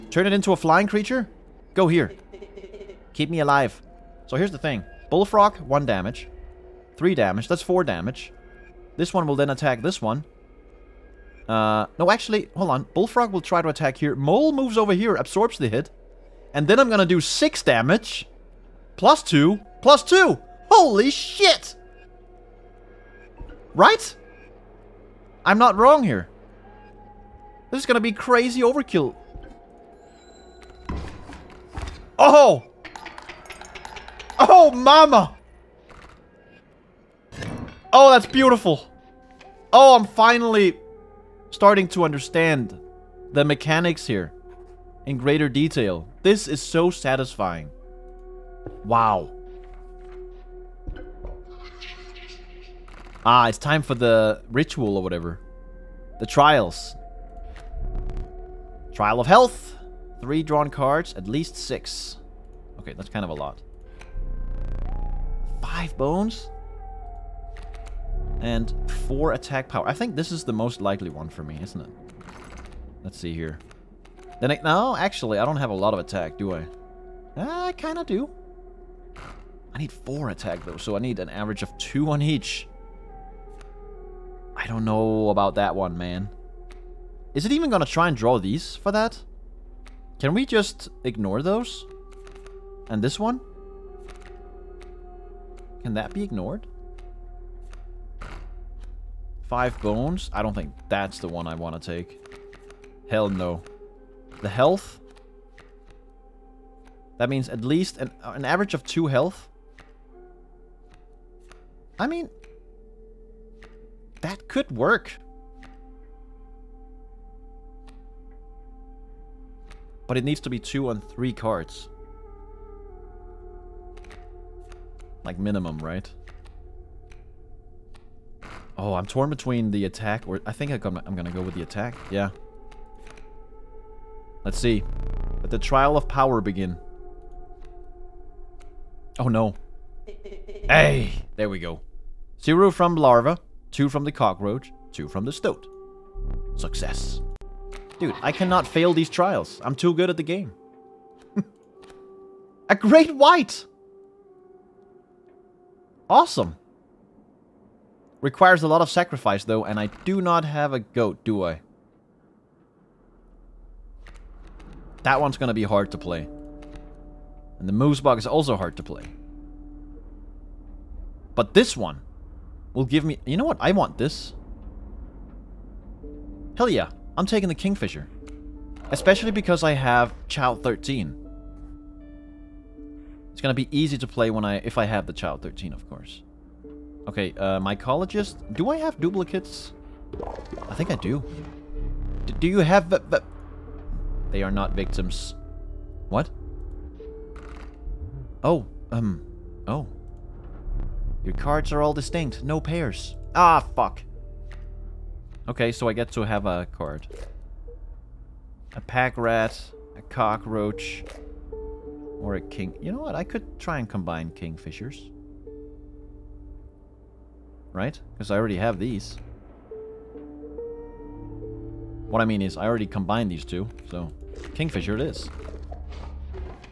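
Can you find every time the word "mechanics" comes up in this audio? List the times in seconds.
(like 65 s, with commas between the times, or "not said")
43 s.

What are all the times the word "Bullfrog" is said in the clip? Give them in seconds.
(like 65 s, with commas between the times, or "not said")
5 s, 12 s.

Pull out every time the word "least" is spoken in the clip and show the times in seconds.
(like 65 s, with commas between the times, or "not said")
61 s, 107 s.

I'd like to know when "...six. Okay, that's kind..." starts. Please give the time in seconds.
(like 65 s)
61 s.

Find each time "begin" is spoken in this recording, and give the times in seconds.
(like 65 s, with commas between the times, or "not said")
136 s.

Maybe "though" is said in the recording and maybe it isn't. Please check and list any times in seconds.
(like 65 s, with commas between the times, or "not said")
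80 s, 159 s.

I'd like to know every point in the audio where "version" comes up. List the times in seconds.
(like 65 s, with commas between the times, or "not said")
not said.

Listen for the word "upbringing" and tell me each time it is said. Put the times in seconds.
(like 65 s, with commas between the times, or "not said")
not said.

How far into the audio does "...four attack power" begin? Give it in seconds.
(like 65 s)
69 s.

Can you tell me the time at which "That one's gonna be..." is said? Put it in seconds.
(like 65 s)
165 s.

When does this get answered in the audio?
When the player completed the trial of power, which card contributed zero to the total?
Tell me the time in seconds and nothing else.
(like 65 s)
142 s.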